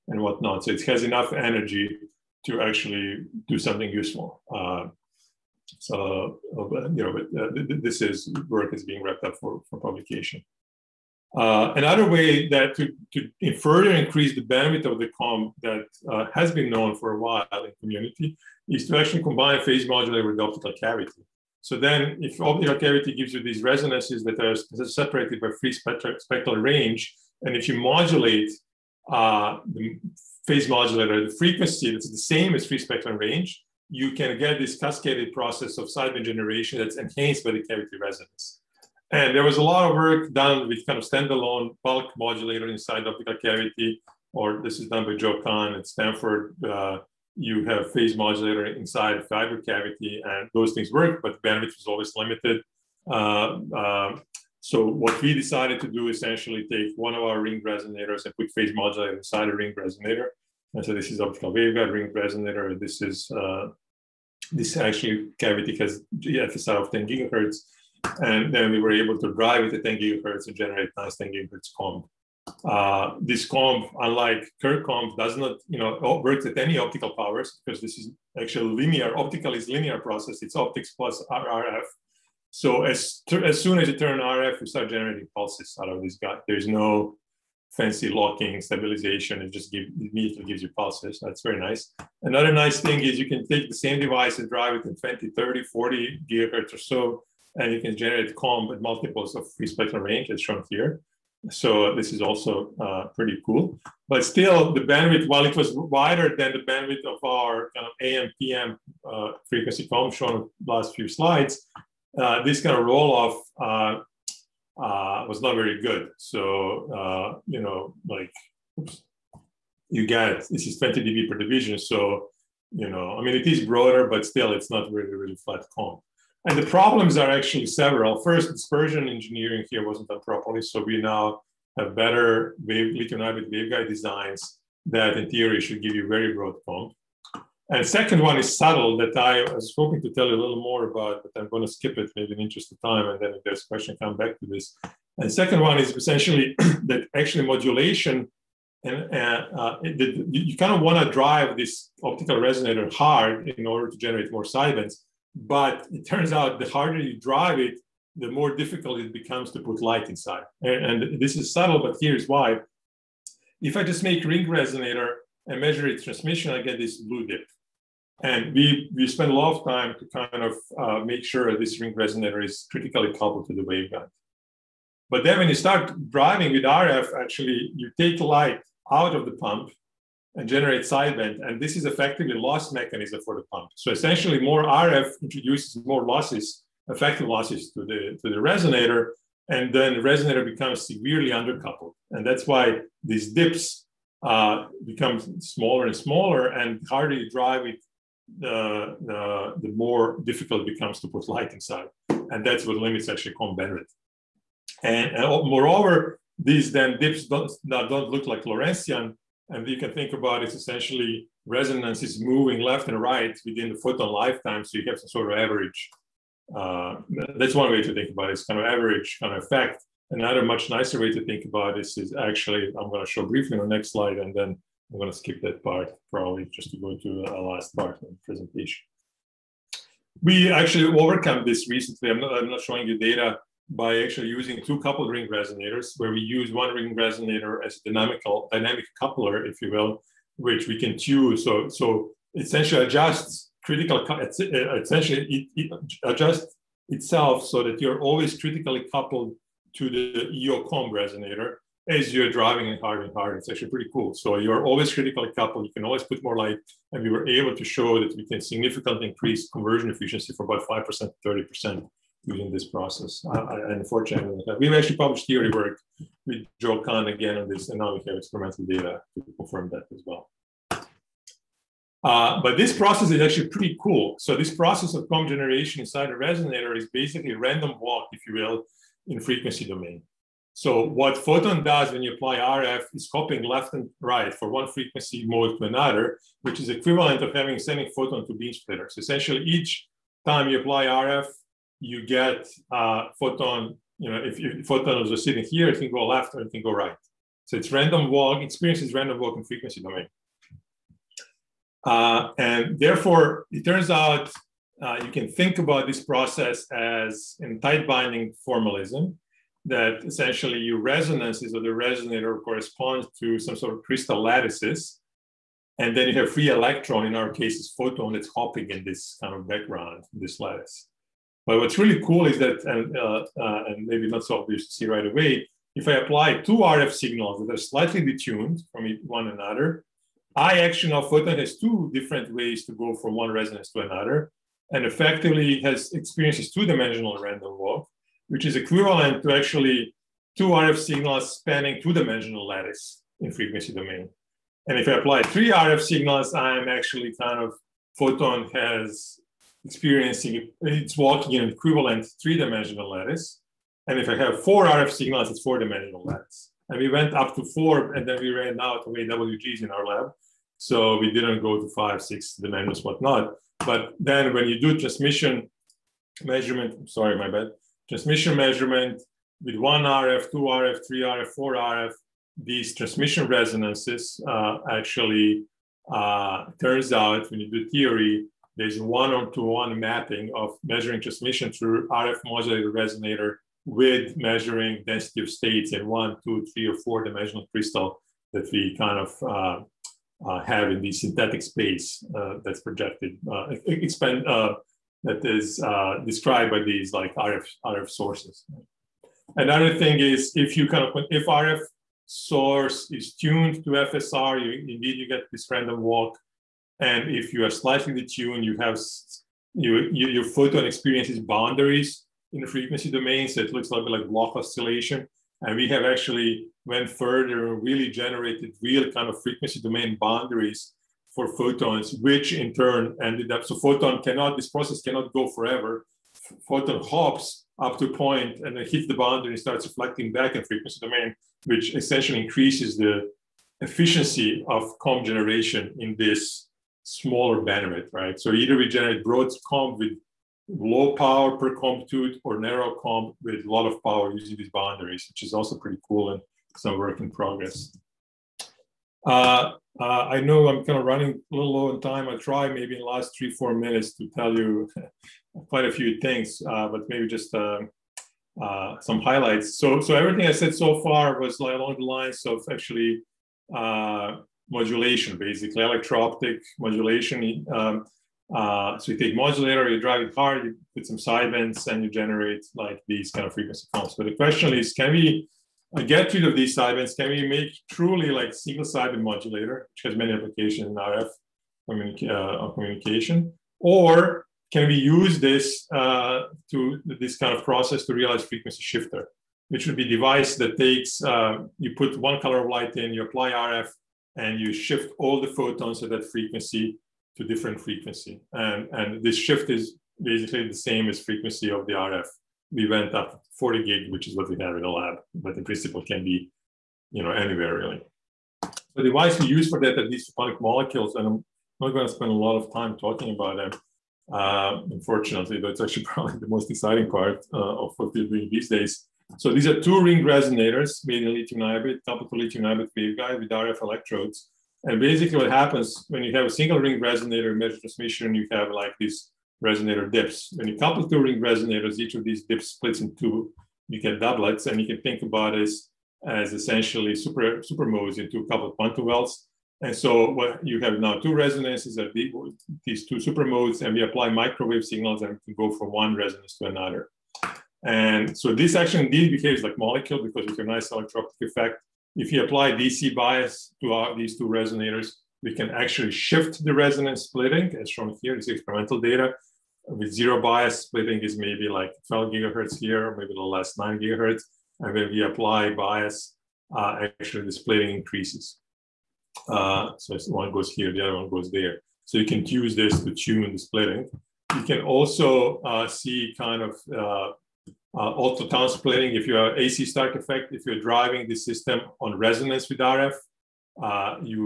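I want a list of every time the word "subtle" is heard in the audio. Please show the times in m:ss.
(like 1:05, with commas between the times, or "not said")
2:18, 2:41.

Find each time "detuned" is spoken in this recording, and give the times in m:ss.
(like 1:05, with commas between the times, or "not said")
5:28, 6:47.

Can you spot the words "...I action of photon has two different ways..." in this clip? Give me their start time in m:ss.
5:30.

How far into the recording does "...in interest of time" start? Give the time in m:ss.
2:22.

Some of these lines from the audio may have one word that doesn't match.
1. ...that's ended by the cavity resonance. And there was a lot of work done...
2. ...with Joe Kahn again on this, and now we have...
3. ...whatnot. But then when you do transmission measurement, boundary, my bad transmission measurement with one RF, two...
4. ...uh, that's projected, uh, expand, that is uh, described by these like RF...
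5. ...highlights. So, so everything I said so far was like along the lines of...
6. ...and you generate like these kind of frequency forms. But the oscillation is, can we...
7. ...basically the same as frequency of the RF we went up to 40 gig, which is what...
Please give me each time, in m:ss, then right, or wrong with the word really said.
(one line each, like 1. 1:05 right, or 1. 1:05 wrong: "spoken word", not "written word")
1. 0:36 wrong: "enhanced", not "ended"
2. 4:26 right
3. 6:02 wrong: "sorry", not "boundary"
4. 6:32 right
5. 7:39 right
6. 7:51 wrong: "question", not "oscillation"
7. 8:20 right.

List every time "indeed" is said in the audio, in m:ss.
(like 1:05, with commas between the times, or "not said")
6:44, 9:08.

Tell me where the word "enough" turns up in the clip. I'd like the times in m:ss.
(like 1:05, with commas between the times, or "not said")
0:01.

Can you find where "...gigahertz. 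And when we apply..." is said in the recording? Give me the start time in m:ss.
9:23.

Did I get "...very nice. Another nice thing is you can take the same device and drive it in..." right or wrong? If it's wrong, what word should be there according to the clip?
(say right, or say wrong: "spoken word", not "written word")
right.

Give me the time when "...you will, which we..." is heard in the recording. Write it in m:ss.
3:59.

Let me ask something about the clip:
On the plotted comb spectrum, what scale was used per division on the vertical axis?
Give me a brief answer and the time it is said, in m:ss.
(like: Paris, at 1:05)
20 dB, at 2:00.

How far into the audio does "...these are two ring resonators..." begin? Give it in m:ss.
8:39.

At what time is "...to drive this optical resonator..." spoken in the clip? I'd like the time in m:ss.
2:31.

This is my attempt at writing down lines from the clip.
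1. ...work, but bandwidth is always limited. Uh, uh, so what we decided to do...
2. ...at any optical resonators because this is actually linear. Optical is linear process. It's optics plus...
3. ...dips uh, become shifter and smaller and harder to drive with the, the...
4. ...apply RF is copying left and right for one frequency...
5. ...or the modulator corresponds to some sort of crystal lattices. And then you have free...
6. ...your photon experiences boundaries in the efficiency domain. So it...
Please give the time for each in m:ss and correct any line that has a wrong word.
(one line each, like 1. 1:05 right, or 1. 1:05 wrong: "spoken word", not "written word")
1. 0:50 right
2. 1:16 wrong: "powers", not "resonators"
3. 3:13 wrong: "smaller", not "shifter"
4. 4:42 right
5. 5:11 wrong: "resonator", not "modulator"
6. 6:50 wrong: "frequency", not "efficiency".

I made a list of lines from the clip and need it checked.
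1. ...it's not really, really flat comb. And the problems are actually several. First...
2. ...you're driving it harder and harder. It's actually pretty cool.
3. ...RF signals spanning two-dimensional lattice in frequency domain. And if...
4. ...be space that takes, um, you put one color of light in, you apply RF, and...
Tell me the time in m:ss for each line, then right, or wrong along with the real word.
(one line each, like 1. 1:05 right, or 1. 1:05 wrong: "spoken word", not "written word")
1. 2:04 right
2. 4:12 right
3. 5:40 right
4. 8:09 wrong: "device", not "space".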